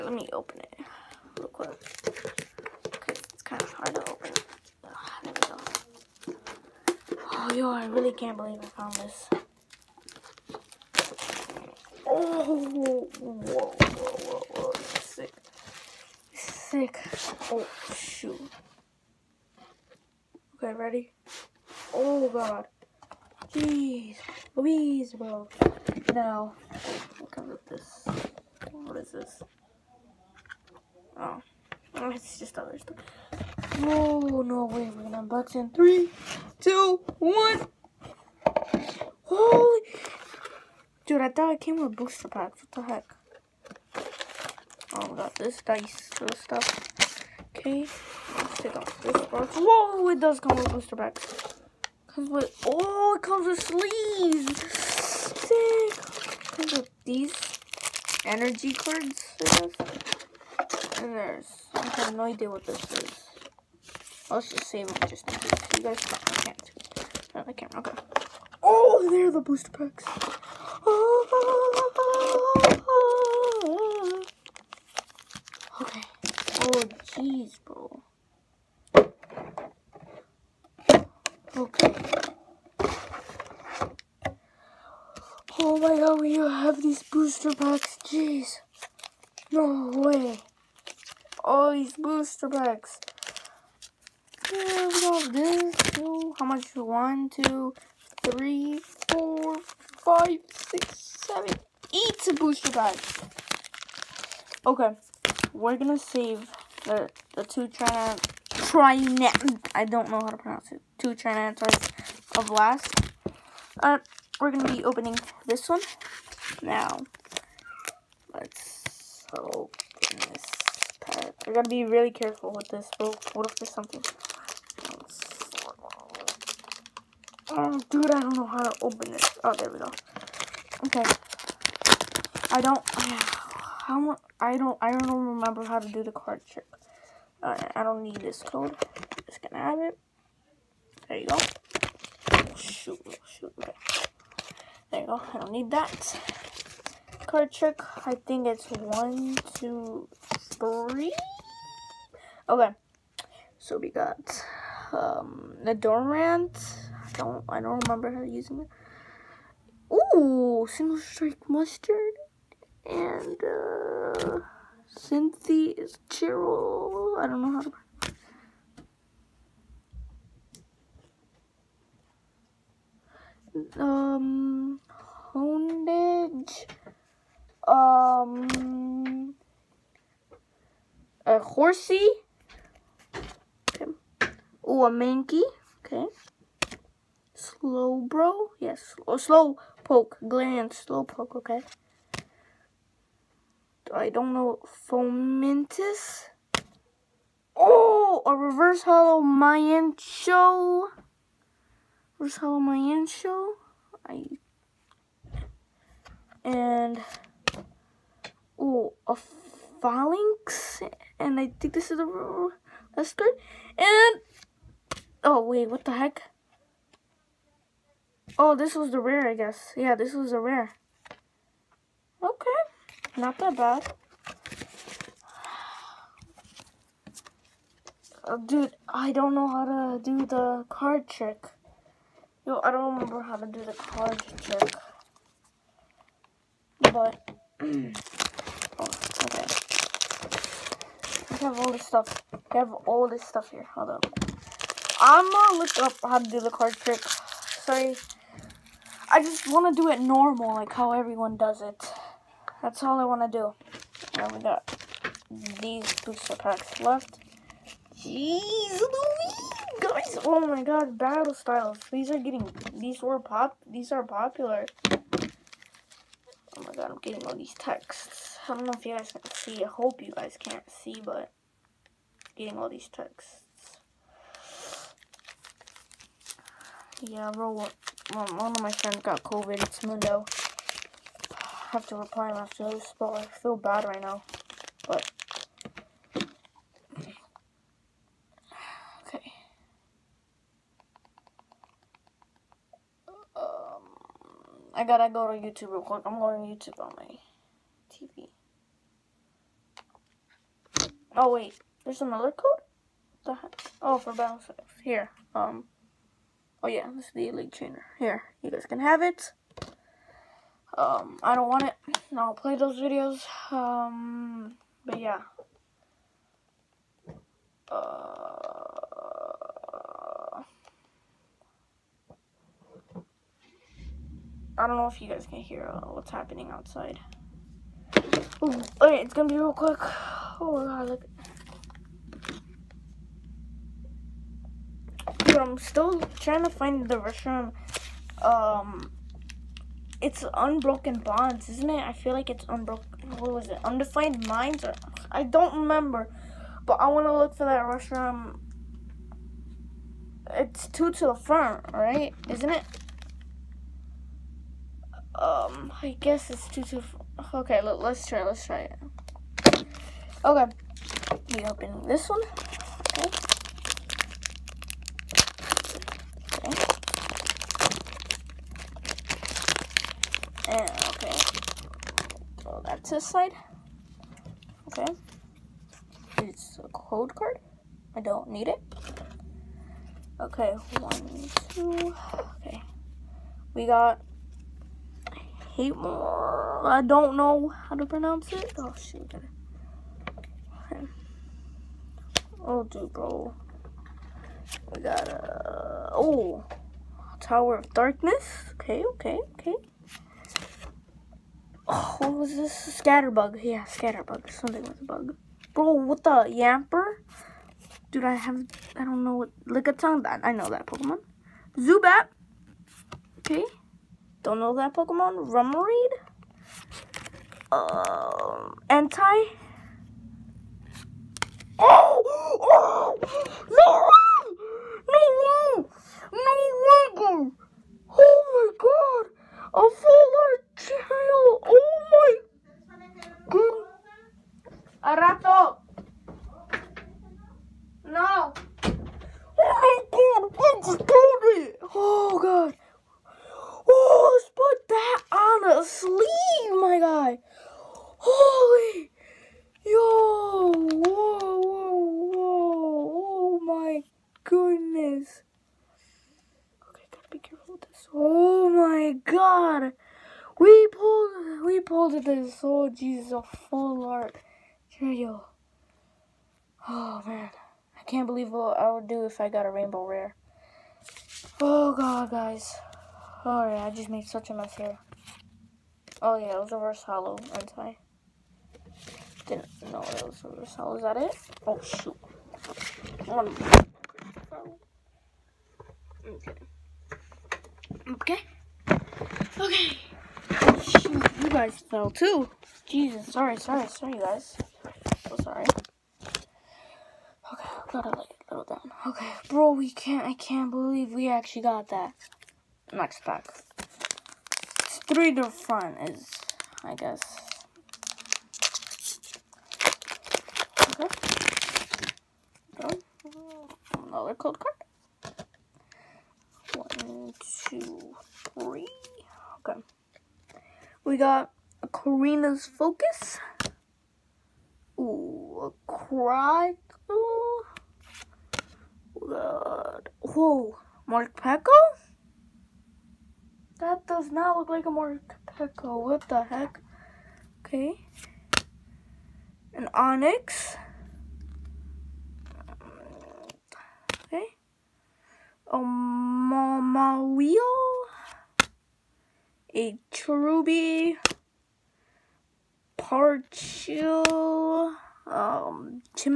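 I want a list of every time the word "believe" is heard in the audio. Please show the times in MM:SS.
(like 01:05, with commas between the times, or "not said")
00:08, 07:48, 08:20.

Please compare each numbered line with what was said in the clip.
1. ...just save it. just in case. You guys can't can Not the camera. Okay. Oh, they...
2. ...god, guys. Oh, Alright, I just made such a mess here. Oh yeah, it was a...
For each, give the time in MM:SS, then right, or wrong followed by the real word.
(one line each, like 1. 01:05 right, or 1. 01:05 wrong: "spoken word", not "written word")
1. 01:04 right
2. 07:51 right.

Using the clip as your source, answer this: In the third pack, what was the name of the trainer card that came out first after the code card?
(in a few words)
Korrina's Focus.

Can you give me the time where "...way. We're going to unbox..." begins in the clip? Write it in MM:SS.
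00:34.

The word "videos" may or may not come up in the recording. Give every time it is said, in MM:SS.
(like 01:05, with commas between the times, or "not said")
05:12.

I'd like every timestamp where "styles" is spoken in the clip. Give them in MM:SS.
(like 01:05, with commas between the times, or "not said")
04:21, 05:04.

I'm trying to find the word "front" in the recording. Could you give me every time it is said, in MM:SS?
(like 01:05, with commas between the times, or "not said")
05:51, 08:25.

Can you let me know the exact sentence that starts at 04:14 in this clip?
And we got these booster packs left.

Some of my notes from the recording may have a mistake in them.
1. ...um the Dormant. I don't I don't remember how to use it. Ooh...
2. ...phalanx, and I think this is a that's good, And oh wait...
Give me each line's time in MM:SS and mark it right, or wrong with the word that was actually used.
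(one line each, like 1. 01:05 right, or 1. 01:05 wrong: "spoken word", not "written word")
1. 02:34 right
2. 03:29 right.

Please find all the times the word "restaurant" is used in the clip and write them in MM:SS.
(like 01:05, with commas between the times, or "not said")
05:36, 05:47.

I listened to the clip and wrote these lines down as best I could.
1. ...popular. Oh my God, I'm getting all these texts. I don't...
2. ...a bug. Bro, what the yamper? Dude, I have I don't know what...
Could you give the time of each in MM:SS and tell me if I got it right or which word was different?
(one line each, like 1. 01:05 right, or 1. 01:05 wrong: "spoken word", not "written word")
1. 04:24 right
2. 06:44 right.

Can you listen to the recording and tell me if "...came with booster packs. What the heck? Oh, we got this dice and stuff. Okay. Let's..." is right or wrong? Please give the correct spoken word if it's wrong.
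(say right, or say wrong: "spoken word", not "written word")
right.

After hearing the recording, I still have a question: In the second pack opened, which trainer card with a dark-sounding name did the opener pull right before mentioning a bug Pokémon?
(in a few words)
Tower of Darkness.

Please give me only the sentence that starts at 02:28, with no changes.
I think it's one, two, three.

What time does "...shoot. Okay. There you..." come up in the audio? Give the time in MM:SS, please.
02:23.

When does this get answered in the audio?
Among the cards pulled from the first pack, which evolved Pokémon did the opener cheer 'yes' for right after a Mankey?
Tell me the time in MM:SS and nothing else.
03:07.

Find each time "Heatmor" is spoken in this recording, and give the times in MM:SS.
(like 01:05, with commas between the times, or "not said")
06:25.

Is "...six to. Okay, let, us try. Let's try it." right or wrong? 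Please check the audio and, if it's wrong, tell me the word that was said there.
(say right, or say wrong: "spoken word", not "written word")
wrong: "two", not "six".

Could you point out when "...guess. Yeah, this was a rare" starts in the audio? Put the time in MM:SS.
03:39.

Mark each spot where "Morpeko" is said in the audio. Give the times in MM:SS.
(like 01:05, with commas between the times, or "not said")
08:50.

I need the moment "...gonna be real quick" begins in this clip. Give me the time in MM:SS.
05:29.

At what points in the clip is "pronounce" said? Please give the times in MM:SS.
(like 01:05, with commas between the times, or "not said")
01:50, 06:27.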